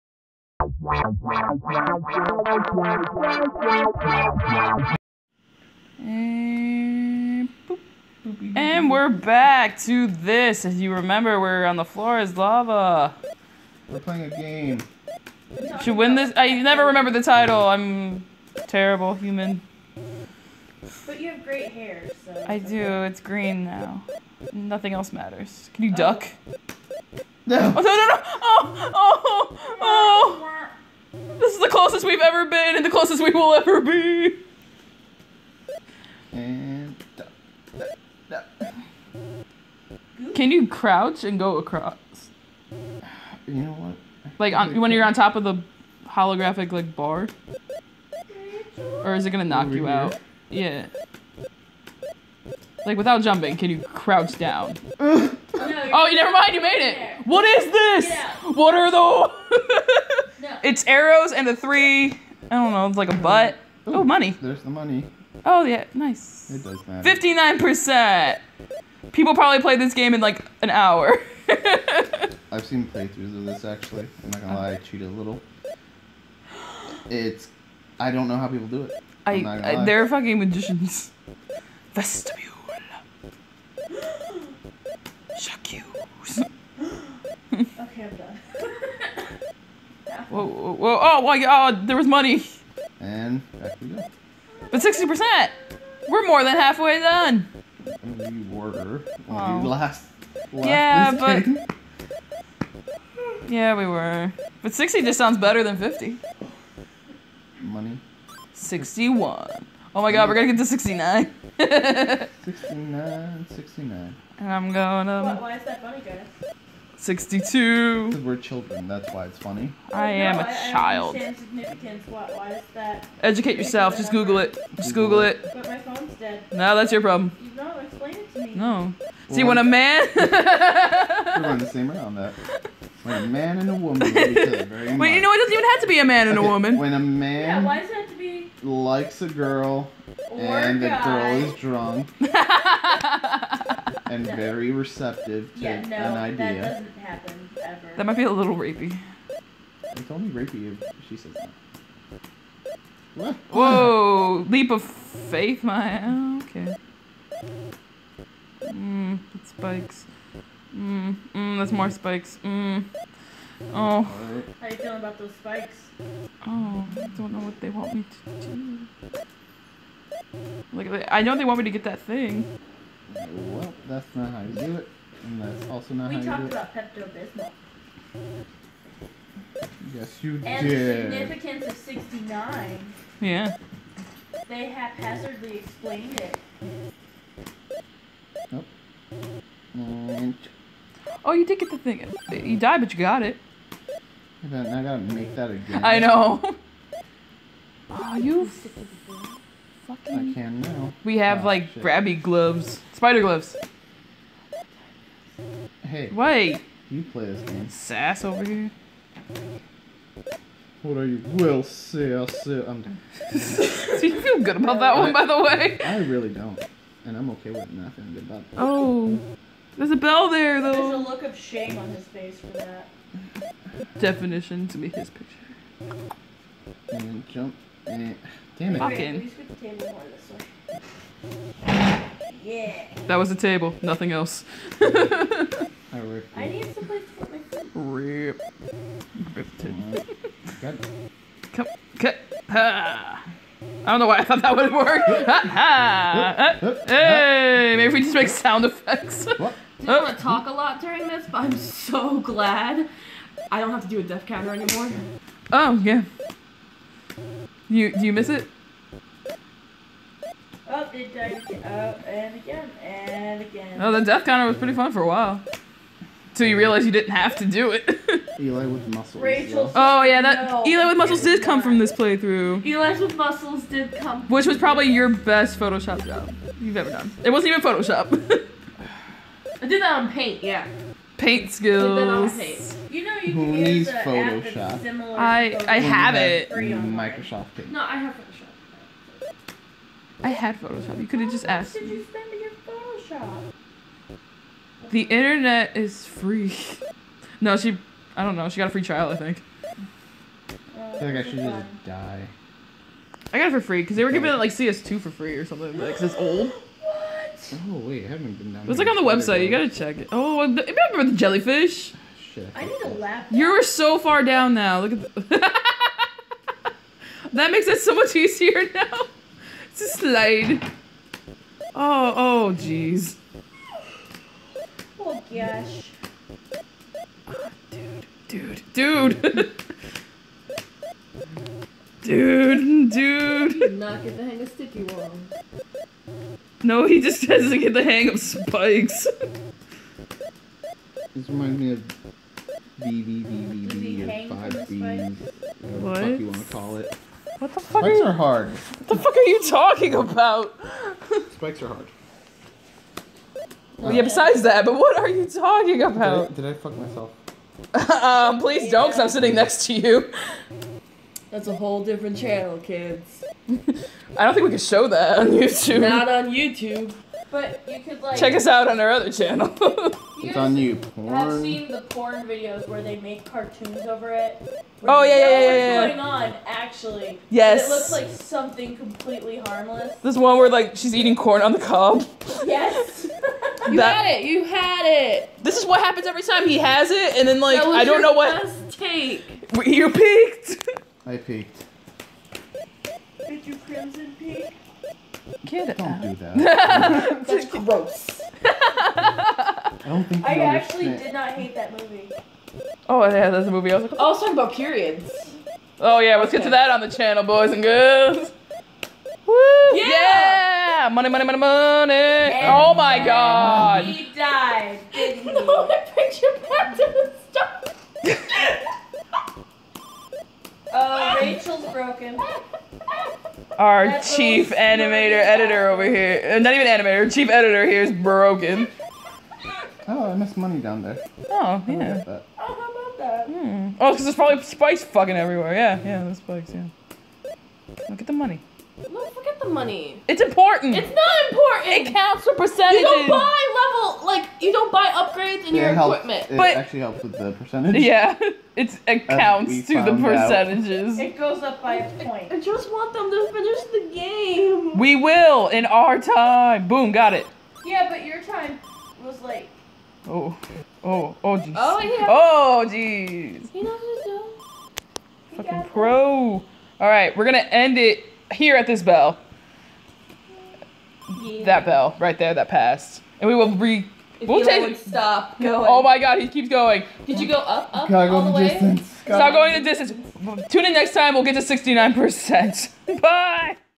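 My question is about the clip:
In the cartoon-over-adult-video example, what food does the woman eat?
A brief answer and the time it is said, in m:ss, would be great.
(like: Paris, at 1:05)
Corn on the cob, at 6:21.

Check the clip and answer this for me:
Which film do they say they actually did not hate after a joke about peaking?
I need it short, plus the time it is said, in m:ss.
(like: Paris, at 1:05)
Crimson Peak, at 6:33.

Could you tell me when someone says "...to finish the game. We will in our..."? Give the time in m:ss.
7:33.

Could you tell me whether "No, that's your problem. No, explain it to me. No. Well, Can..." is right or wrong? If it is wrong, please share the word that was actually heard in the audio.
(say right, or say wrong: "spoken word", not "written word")
wrong: "See", not "Can".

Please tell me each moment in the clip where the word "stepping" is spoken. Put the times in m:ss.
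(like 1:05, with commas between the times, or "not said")
not said.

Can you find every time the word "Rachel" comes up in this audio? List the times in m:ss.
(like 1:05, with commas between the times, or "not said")
4:29, 7:01.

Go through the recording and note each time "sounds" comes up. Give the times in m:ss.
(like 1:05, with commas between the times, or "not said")
1:45, 4:08.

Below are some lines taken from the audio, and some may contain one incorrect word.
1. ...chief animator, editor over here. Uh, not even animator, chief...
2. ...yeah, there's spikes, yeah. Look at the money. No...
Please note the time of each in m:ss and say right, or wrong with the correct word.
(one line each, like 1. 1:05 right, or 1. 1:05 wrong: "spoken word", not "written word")
1. 7:04 right
2. 7:15 right.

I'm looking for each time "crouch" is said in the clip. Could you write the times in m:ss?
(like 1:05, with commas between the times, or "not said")
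0:40, 0:53.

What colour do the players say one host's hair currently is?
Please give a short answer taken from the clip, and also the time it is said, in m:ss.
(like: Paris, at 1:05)
Green, at 0:23.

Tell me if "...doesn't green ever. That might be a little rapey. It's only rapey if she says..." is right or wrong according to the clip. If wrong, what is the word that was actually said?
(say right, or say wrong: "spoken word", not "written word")
wrong: "happen", not "green".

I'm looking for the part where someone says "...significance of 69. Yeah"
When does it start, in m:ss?
3:01.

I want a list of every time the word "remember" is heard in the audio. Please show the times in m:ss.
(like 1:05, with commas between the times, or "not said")
0:10, 0:16, 5:10.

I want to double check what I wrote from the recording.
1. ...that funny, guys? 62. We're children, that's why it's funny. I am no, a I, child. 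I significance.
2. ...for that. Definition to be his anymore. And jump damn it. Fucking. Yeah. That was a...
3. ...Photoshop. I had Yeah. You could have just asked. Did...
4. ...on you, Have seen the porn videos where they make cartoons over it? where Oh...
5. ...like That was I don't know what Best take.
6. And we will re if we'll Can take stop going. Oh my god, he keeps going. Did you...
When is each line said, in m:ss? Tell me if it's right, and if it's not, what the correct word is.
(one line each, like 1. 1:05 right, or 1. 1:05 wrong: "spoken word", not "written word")
1. 1:55 right
2. 3:42 wrong: "picture", not "anymore"
3. 4:48 wrong: "Photoshop", not "Yeah"
4. 6:10 right
5. 6:27 right
6. 7:53 wrong: "Eli", not "Can".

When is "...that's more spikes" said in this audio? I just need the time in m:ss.
2:41.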